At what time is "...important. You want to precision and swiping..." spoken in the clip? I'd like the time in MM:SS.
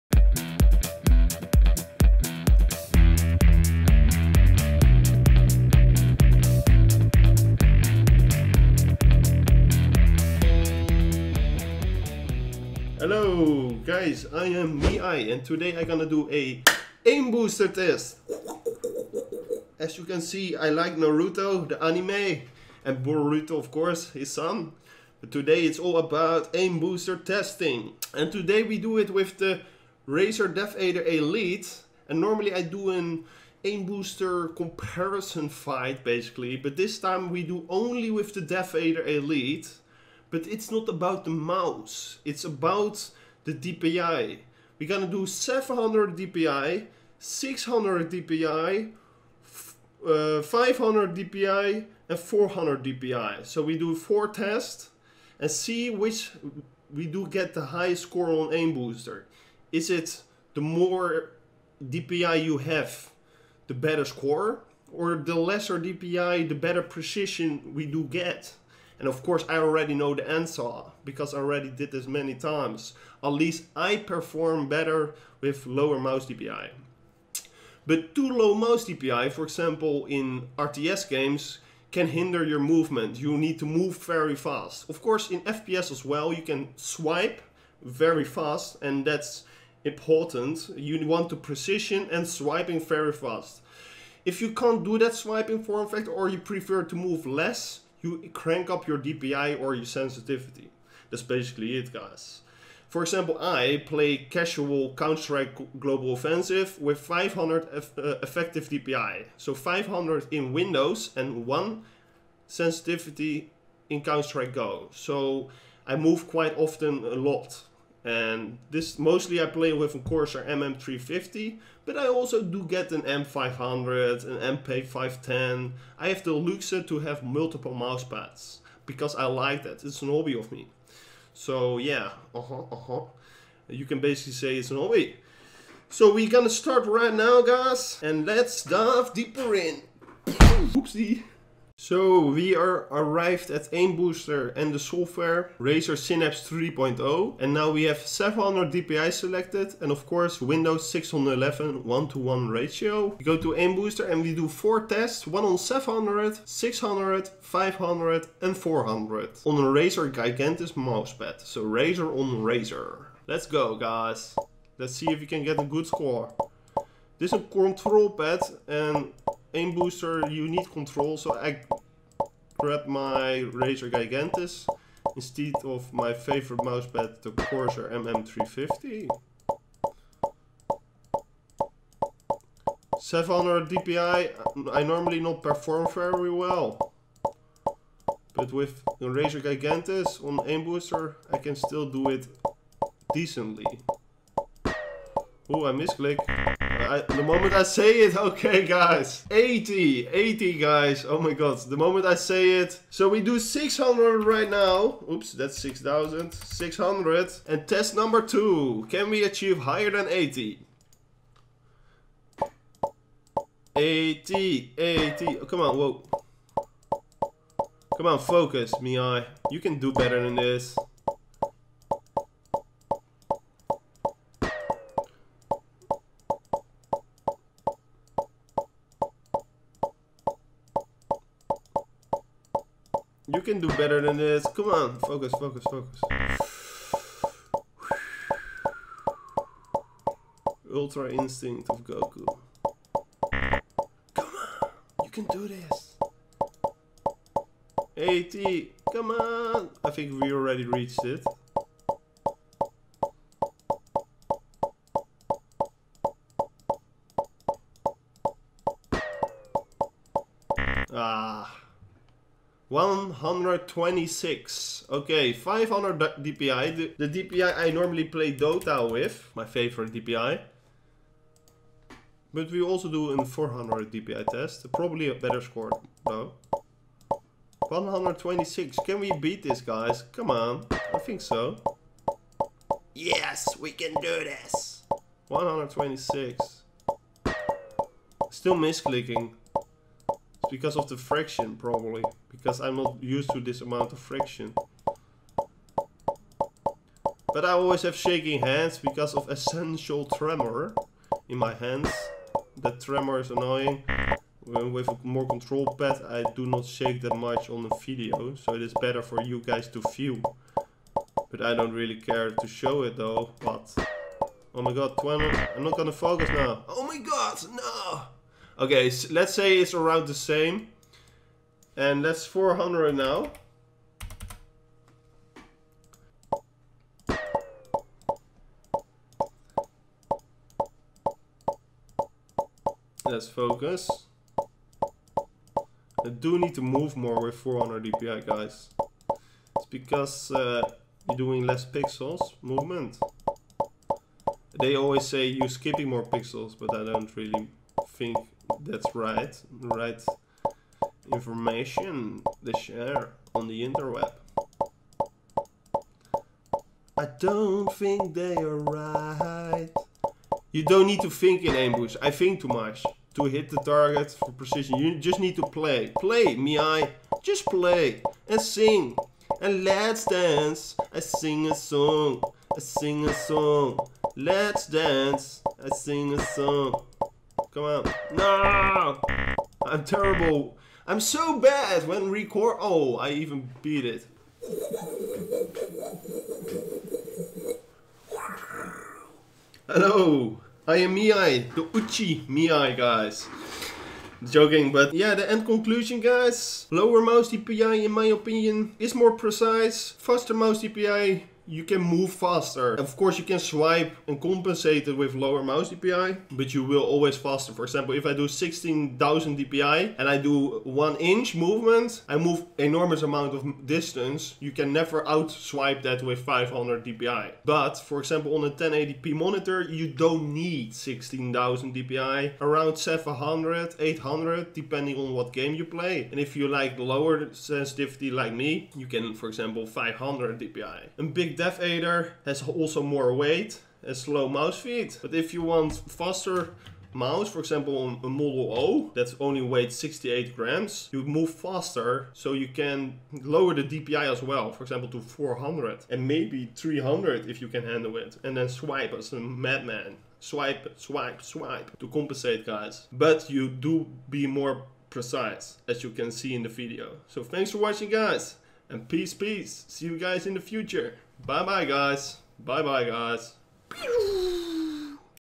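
01:29.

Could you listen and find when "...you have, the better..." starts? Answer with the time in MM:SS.
01:02.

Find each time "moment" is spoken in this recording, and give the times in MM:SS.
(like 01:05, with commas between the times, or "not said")
03:17, 03:21.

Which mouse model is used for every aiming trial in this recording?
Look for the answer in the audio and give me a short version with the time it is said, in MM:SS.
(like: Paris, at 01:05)
Razer DeathAdder Elite, at 00:30.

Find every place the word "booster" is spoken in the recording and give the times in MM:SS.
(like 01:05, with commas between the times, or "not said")
00:17, 00:26, 00:33, 00:58, 02:23, 02:33, 02:49, 03:10.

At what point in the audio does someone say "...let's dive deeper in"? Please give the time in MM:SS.
02:18.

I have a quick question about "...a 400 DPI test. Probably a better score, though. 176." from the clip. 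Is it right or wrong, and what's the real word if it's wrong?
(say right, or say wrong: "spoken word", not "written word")
wrong: "126", not "176".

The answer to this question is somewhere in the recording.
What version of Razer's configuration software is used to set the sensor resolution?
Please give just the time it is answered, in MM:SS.
02:25.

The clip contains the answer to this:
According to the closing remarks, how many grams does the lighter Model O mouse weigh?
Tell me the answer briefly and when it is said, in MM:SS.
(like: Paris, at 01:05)
68 grams, at 07:19.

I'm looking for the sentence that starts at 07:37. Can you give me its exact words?
So thanks for watching guys and peace peace.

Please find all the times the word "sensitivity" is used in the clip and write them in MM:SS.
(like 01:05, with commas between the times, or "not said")
01:39, 01:52, 07:07.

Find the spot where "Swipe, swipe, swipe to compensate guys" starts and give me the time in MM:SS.
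07:30.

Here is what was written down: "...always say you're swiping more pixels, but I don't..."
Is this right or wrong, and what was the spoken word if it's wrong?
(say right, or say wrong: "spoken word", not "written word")
wrong: "skipping", not "swiping".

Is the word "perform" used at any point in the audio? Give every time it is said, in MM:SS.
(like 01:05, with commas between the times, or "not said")
01:13, 03:05.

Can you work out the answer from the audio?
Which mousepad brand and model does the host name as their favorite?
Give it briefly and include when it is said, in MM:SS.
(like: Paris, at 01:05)
Corsair MM350, at 02:57.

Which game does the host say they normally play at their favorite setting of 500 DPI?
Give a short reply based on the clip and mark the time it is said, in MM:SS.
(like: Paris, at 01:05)
Dota, at 04:28.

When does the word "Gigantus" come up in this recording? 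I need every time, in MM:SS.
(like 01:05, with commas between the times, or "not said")
02:40, 02:53, 03:09.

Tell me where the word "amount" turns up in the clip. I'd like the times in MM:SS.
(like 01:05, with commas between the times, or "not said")
04:53, 06:53.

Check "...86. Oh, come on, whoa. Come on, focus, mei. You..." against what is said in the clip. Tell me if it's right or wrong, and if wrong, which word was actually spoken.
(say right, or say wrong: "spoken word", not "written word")
wrong: "80", not "86".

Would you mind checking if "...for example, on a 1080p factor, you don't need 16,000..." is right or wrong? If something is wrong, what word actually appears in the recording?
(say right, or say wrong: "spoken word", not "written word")
wrong: "monitor", not "factor".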